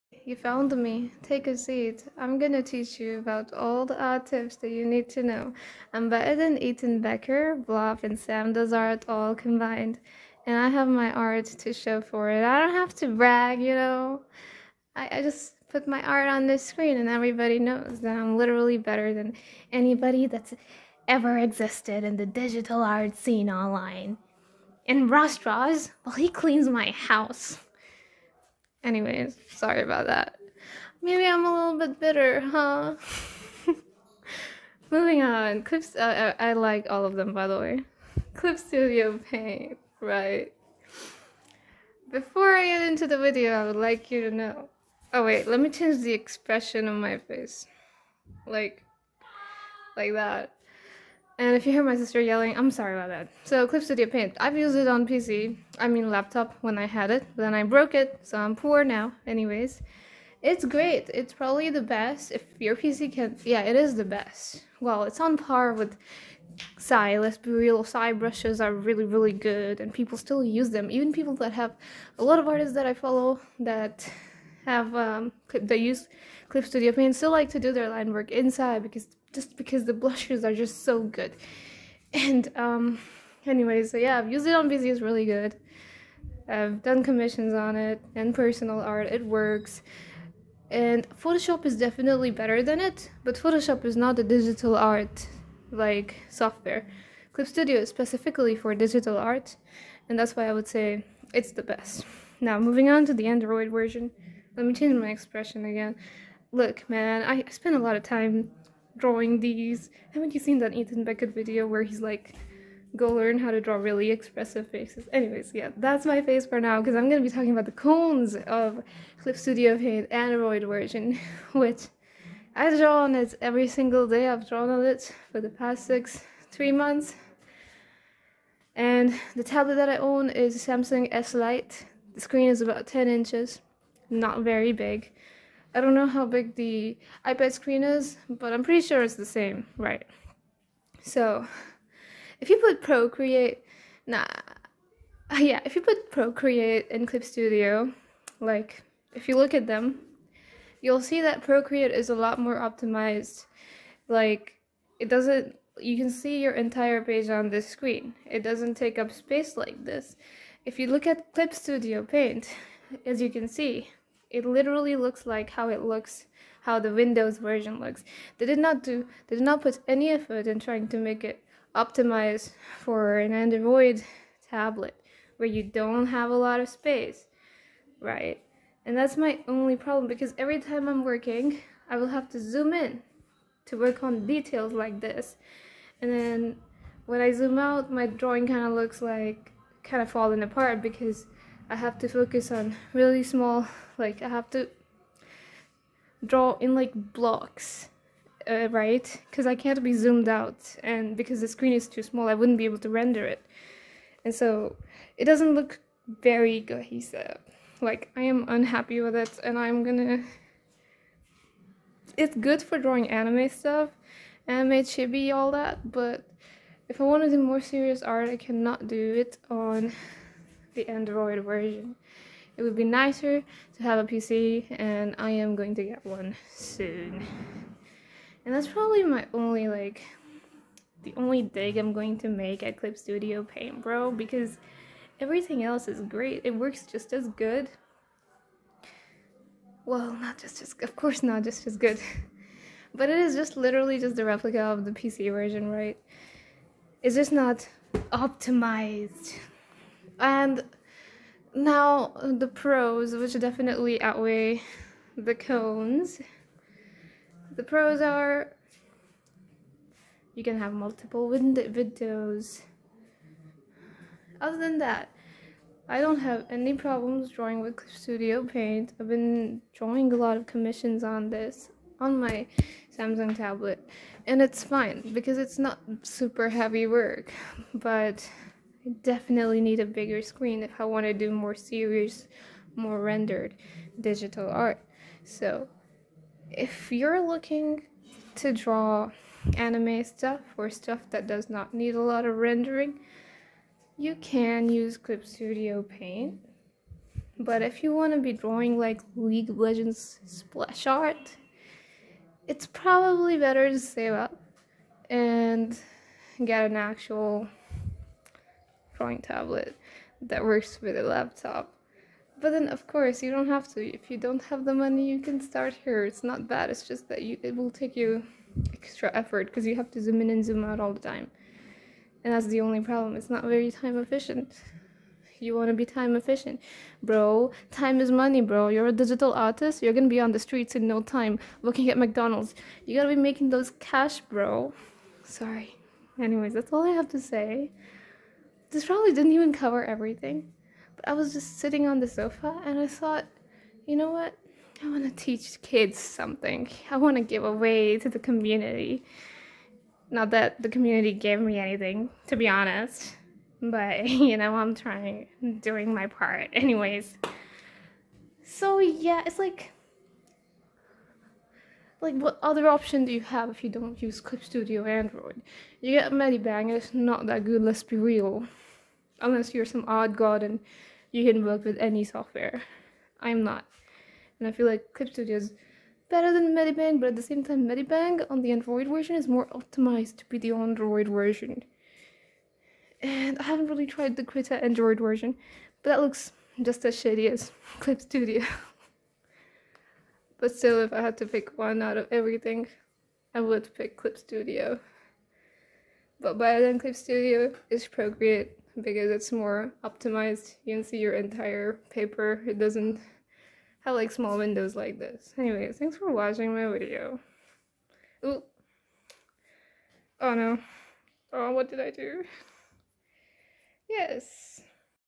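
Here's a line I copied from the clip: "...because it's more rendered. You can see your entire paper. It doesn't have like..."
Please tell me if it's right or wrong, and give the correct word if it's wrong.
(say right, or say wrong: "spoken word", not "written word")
wrong: "optimized", not "rendered".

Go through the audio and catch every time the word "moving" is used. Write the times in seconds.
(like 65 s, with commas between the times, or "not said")
34 s, 102 s.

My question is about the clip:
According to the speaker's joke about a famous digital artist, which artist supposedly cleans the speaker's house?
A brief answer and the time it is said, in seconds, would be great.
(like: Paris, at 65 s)
Ross Draws, at 25 s.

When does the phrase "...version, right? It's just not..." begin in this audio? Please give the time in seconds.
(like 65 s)
245 s.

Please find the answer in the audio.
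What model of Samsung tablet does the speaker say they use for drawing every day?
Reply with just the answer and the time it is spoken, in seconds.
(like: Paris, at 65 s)
Samsung S Lite, at 130 s.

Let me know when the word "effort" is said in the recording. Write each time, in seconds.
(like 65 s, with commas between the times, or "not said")
170 s, 319 s.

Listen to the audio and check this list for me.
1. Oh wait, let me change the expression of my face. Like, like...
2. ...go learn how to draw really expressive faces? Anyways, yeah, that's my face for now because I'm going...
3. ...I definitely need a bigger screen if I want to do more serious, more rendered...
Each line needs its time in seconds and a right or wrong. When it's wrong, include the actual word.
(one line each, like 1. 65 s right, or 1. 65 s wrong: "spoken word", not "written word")
1. 45 s right
2. 112 s right
3. 278 s right.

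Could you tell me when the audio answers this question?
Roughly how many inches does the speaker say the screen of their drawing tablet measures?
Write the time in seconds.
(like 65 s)
132 s.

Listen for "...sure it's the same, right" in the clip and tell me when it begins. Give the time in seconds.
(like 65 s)
138 s.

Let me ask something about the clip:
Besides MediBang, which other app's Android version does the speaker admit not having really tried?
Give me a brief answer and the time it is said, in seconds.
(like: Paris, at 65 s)
Krita, at 384 s.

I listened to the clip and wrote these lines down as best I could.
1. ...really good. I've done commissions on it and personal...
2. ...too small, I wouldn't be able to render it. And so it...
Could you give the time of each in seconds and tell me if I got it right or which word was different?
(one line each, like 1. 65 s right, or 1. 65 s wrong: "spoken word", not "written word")
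1. 85 s right
2. 201 s right.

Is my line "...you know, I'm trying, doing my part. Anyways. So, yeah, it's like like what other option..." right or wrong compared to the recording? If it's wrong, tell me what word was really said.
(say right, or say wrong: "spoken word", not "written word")
right.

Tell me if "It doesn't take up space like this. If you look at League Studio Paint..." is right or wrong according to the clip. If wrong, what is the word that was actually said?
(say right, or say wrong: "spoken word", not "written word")
wrong: "Clip", not "League".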